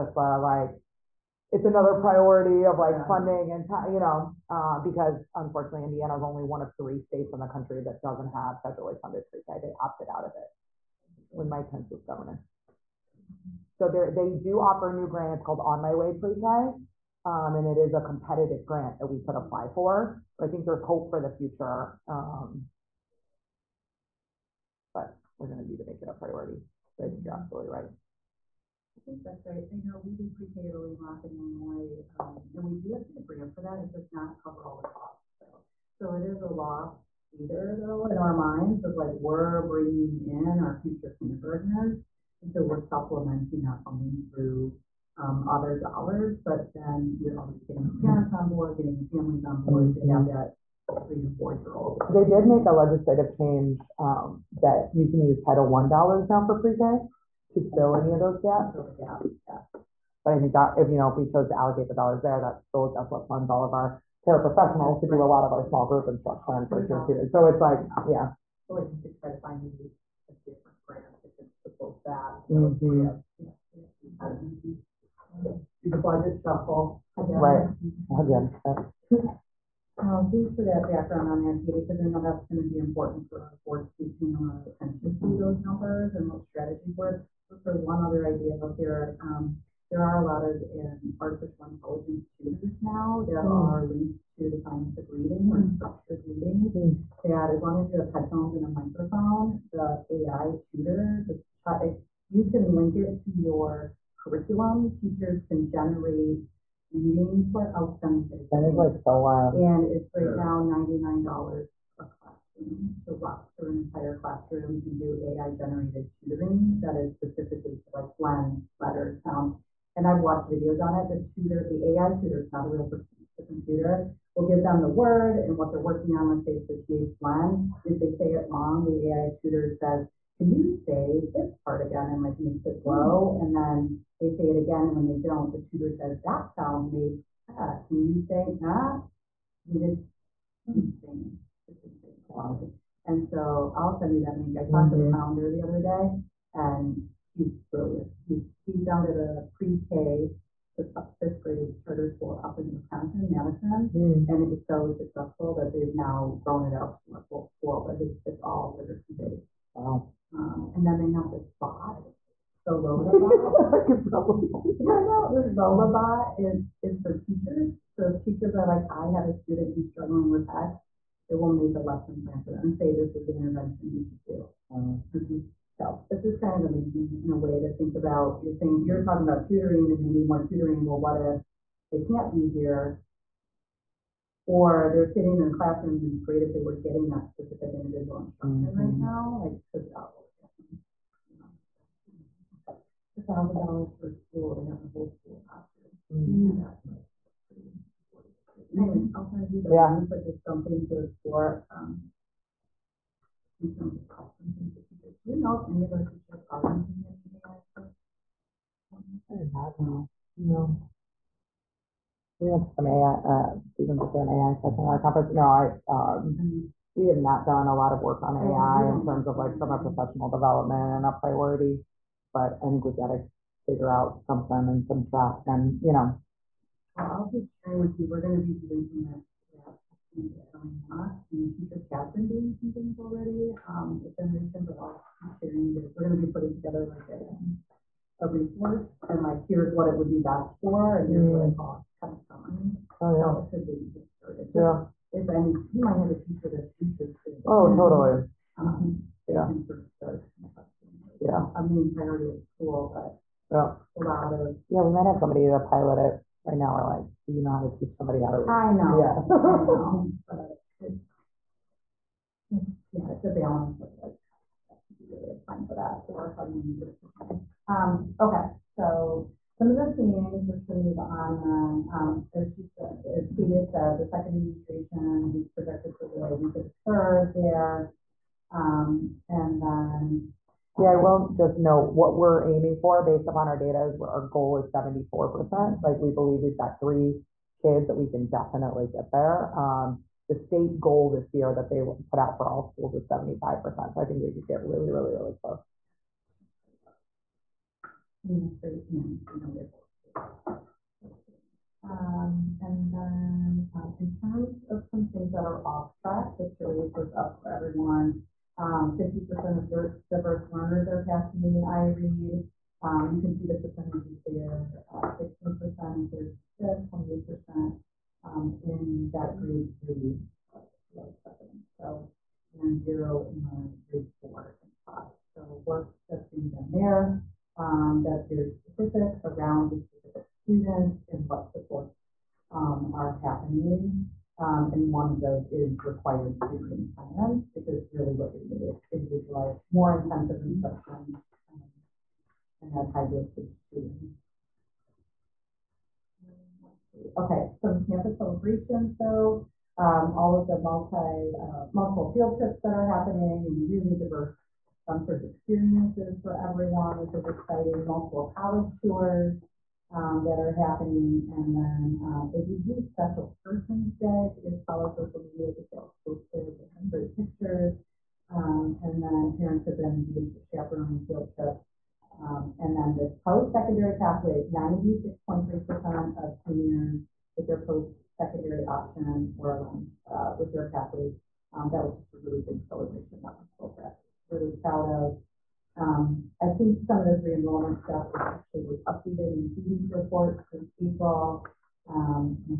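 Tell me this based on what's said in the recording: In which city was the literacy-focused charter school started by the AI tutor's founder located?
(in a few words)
Madison.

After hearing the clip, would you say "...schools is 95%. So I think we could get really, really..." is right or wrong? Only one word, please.
wrong.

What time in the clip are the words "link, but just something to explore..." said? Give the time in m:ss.
3:19.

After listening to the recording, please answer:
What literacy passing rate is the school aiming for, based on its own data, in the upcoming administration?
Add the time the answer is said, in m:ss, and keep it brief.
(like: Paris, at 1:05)
74%, at 4:44.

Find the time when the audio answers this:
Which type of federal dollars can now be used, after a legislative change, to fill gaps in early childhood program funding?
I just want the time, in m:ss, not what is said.
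0:55.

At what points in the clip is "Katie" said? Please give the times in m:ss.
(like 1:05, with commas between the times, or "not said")
1:21, 4:33.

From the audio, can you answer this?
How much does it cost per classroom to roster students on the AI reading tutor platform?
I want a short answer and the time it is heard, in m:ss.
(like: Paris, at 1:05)
$99, at 1:50.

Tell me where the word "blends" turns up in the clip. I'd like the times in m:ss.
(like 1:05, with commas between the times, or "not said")
1:58, 2:07.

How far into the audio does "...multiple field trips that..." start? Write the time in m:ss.
5:51.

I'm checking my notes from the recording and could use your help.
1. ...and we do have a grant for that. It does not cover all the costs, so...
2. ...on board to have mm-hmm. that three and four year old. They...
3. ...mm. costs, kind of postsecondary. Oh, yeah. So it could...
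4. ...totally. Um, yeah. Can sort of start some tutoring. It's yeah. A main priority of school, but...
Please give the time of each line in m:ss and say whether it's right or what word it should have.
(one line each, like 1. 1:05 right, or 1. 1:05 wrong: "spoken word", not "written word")
1. 0:32 right
2. 0:49 right
3. 4:01 wrong: "summary", not "postsecondary"
4. 4:07 wrong: "testing", not "tutoring".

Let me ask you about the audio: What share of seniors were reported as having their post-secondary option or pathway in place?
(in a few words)
96.3%.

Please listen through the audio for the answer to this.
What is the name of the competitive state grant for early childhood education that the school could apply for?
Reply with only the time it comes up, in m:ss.
0:15.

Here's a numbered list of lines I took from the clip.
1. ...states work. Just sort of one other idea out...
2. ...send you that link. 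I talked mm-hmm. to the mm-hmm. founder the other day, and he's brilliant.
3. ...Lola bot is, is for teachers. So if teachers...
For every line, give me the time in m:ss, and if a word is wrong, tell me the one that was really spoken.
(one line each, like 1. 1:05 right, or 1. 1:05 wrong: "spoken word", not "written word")
1. 1:26 wrong: "strategies", not "states"
2. 2:23 right
3. 2:45 right.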